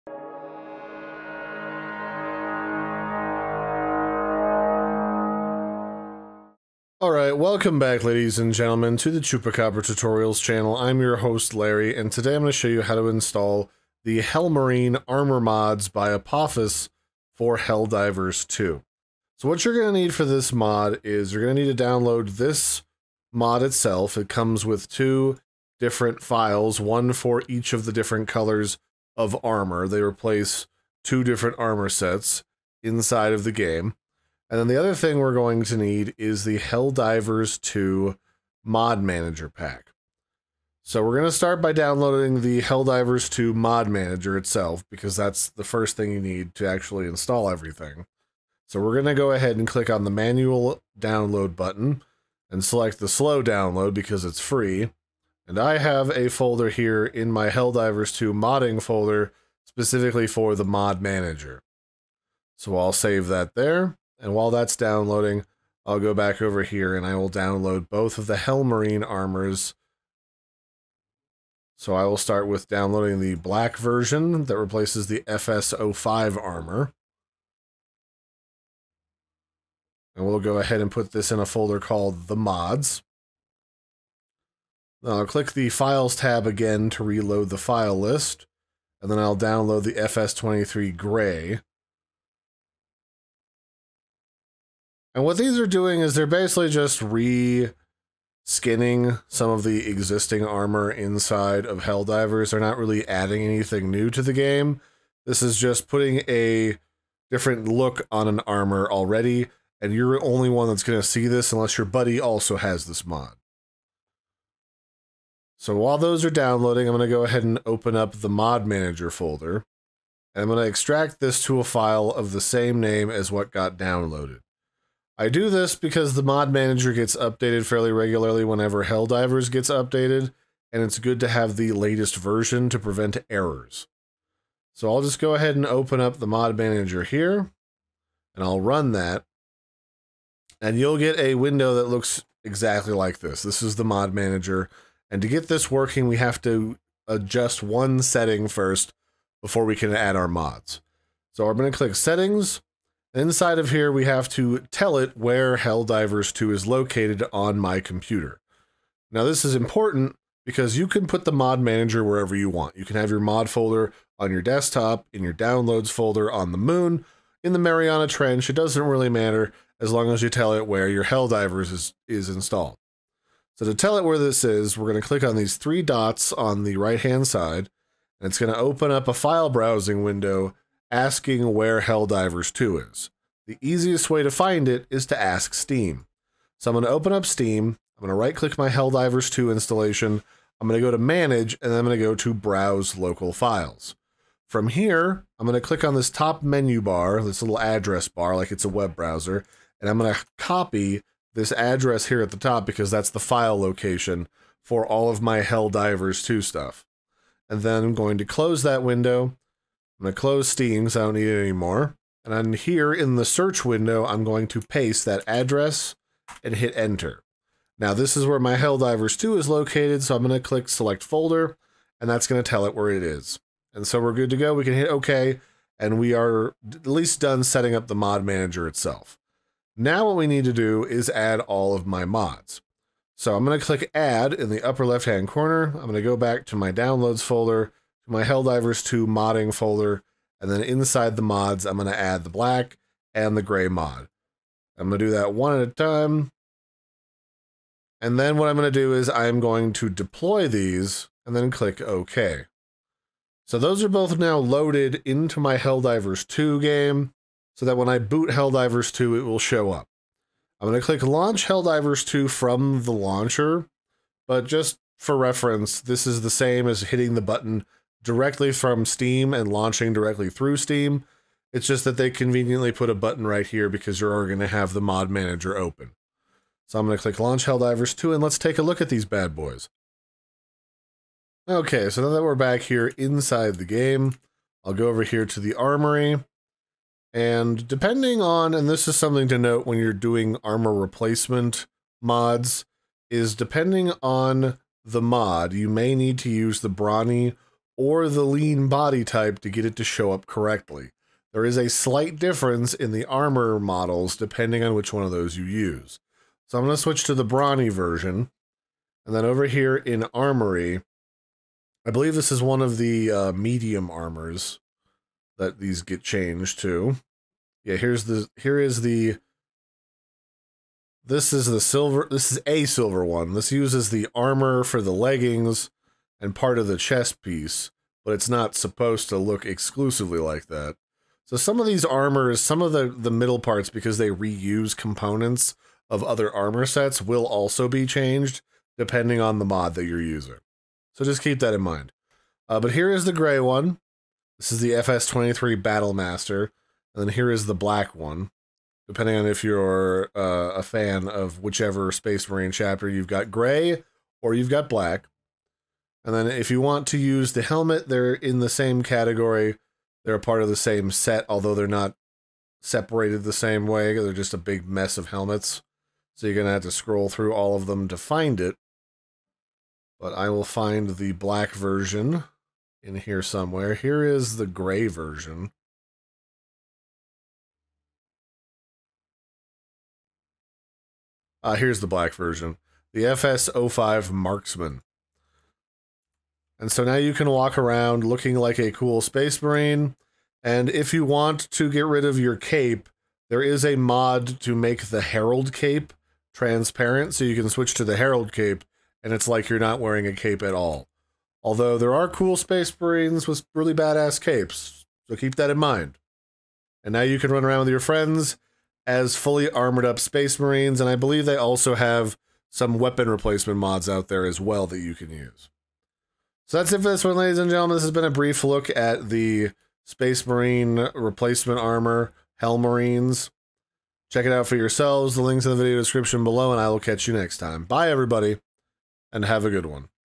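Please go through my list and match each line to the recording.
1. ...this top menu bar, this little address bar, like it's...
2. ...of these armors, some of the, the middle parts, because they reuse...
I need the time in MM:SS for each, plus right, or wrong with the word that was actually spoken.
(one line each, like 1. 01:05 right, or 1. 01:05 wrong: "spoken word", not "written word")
1. 03:15 right
2. 05:31 right.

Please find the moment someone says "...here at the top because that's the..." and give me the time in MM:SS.
03:22.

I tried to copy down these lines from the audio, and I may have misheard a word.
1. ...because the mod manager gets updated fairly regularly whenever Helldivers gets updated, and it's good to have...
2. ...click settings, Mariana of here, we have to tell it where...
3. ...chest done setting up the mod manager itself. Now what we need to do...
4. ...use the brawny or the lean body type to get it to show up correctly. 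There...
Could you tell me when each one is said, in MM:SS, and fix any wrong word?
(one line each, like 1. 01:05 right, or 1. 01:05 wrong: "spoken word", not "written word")
1. 02:05 right
2. 02:31 wrong: "Inside", not "Mariana"
3. 03:46 wrong: "least", not "chest"
4. 04:56 right.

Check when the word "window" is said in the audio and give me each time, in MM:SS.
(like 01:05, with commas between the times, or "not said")
02:21, 03:00, 03:28, 03:33.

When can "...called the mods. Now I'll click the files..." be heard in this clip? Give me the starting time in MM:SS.
01:21.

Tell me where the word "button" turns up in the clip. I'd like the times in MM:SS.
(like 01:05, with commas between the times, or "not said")
00:51, 04:27, 04:32.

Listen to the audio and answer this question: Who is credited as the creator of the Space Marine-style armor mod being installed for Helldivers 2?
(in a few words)
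Apophis.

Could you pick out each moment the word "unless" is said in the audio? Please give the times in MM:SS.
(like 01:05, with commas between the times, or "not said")
01:51.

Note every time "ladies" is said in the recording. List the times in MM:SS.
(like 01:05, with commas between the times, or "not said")
00:08, 06:57.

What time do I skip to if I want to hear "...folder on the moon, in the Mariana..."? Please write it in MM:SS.
02:45.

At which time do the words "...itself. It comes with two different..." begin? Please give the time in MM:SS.
00:23.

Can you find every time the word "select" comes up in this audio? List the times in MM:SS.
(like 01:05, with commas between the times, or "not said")
00:52, 03:40.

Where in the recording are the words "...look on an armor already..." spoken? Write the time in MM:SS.
01:47.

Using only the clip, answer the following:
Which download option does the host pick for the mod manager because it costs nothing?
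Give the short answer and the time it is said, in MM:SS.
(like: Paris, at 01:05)
slow download, at 00:53.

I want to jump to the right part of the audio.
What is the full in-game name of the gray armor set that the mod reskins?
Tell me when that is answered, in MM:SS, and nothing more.
05:44.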